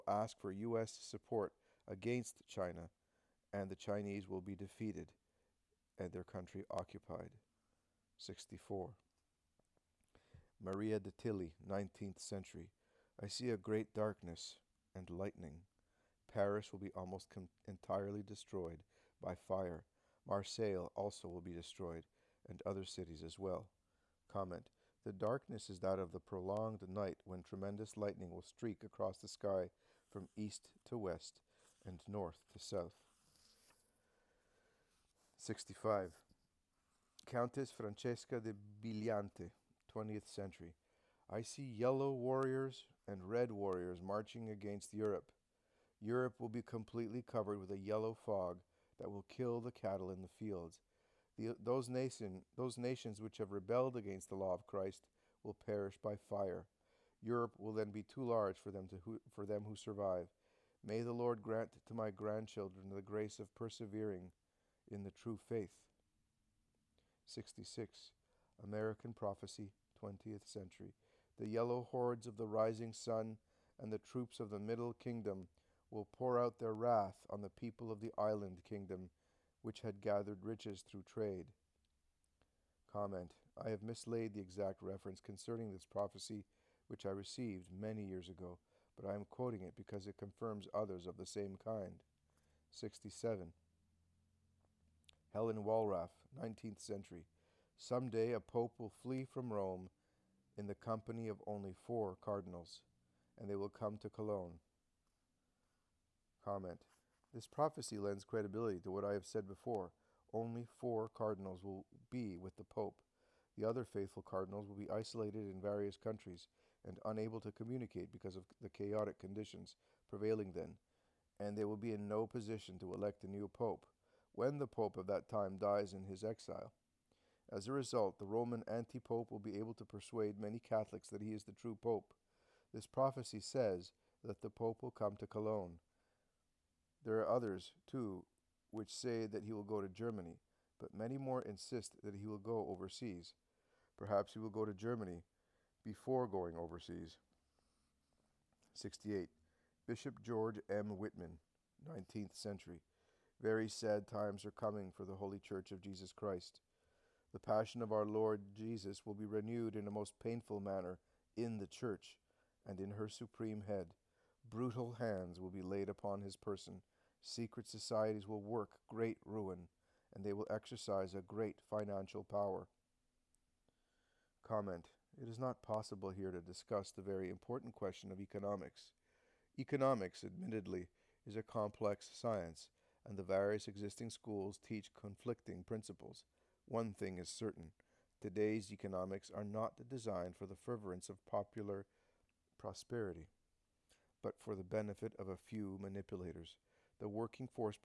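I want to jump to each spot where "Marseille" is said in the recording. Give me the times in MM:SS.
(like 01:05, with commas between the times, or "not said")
00:20.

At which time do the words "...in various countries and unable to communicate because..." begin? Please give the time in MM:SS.
01:55.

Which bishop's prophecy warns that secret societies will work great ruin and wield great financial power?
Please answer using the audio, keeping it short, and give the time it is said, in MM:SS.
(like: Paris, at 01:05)
George M. Wittman, at 02:30.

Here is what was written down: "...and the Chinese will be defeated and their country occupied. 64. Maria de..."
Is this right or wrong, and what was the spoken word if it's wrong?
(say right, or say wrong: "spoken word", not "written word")
right.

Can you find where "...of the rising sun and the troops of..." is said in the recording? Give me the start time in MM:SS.
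01:12.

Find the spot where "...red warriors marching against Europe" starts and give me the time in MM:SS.
00:43.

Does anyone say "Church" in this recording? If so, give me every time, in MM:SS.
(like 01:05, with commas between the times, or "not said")
02:35, 02:41.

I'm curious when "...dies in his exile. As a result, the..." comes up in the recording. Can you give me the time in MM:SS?
02:05.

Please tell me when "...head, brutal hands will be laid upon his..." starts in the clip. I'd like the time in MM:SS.
02:43.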